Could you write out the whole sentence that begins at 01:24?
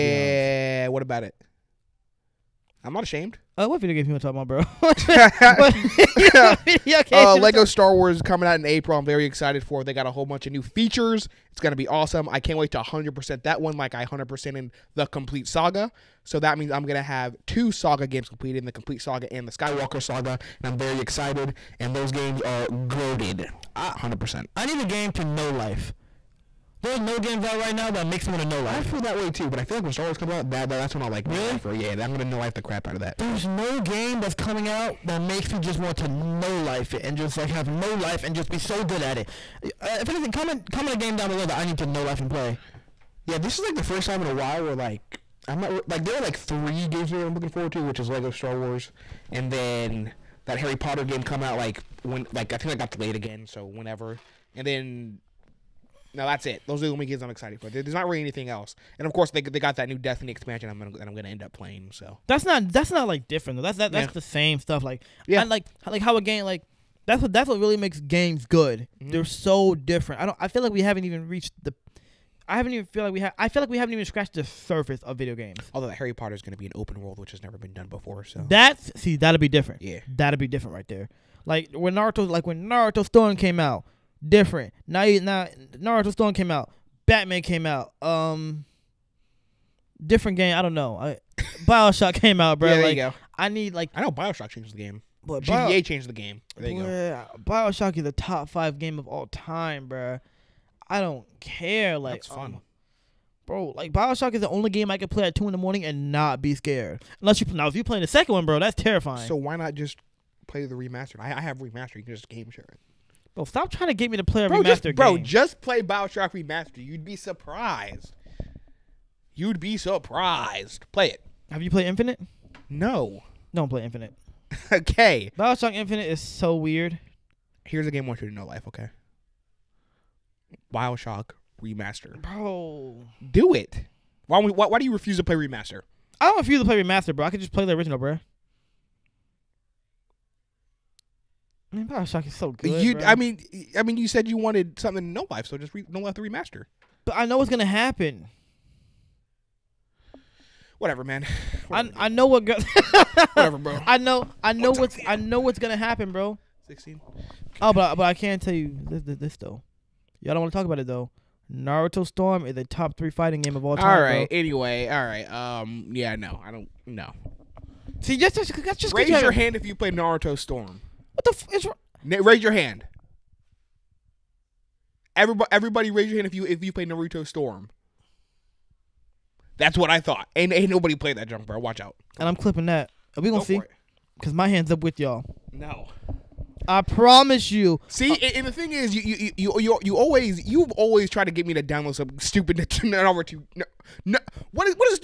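Now you now Naruto Storm came out.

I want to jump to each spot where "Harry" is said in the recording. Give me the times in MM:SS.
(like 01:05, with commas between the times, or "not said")
00:50, 01:15.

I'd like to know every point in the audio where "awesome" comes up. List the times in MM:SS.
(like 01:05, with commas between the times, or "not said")
00:11.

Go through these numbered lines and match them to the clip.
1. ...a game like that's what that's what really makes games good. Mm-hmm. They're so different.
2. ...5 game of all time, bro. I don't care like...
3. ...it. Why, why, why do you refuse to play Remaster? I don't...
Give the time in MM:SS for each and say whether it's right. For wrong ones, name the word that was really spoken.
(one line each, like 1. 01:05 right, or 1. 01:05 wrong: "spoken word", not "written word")
1. 01:06 right
2. 01:38 right
3. 02:13 right.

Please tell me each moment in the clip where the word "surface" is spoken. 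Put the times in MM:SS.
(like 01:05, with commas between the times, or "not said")
01:14.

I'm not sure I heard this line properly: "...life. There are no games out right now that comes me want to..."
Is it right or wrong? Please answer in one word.
wrong.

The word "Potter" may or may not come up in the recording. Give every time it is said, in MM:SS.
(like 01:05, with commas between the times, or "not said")
00:50, 01:16.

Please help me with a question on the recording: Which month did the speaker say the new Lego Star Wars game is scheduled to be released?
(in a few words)
April.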